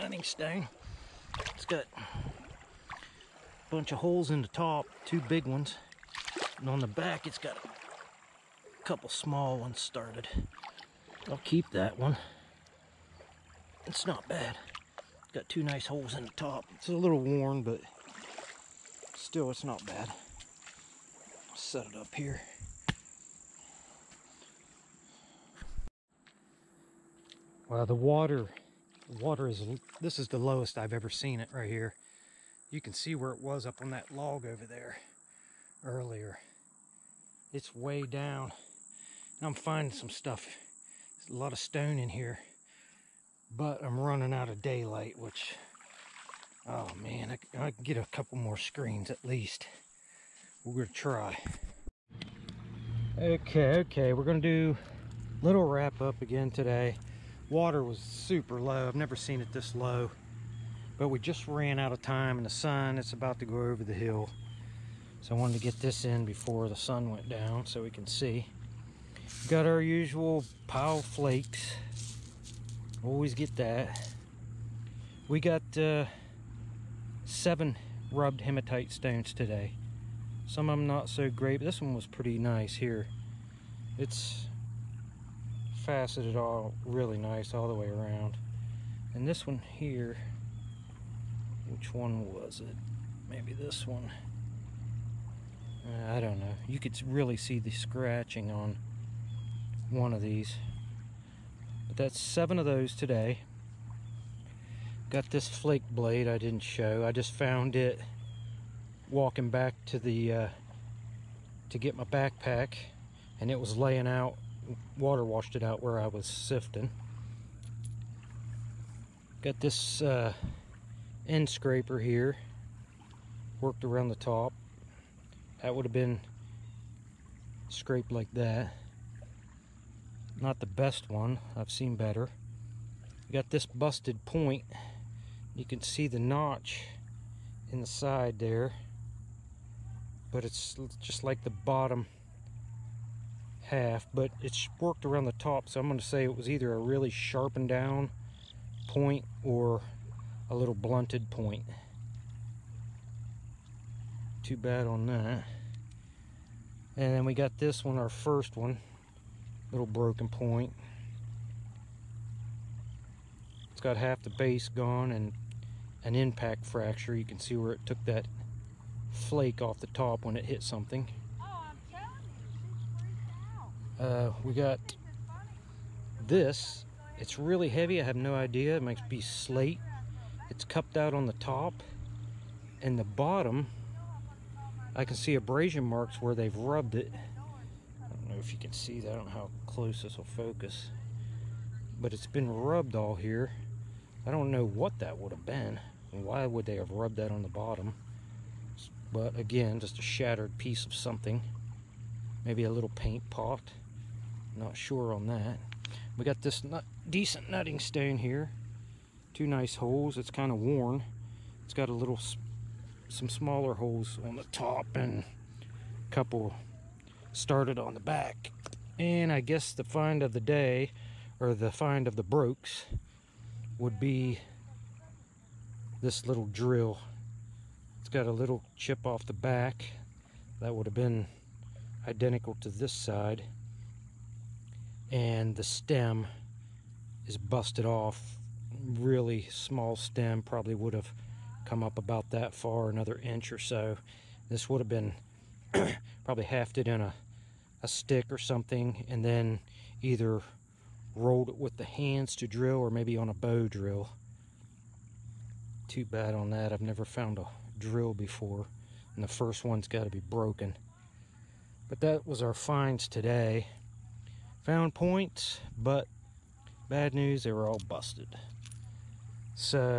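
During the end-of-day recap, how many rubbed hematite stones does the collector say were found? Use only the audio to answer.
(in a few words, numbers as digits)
7.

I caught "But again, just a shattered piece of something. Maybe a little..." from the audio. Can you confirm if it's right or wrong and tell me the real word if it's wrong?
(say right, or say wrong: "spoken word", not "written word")
right.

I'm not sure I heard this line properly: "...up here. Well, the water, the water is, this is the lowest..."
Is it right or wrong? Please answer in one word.
right.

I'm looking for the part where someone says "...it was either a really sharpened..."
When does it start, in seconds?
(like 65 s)
146 s.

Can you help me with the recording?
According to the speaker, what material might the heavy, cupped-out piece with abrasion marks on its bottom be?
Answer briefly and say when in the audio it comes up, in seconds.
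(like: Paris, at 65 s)
slate, at 179 s.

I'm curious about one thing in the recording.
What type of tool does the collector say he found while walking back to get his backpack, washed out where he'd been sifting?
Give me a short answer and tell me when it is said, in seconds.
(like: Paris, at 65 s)
flake blade, at 105 s.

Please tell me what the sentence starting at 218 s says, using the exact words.
And I guess the find of the day, or the find of the brooks, would be this little drill.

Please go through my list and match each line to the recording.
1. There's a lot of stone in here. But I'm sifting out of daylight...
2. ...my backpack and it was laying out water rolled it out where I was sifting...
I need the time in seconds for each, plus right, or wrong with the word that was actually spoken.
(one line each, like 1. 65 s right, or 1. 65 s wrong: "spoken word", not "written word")
1. 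41 s wrong: "running", not "sifting"
2. 111 s wrong: "washed", not "rolled".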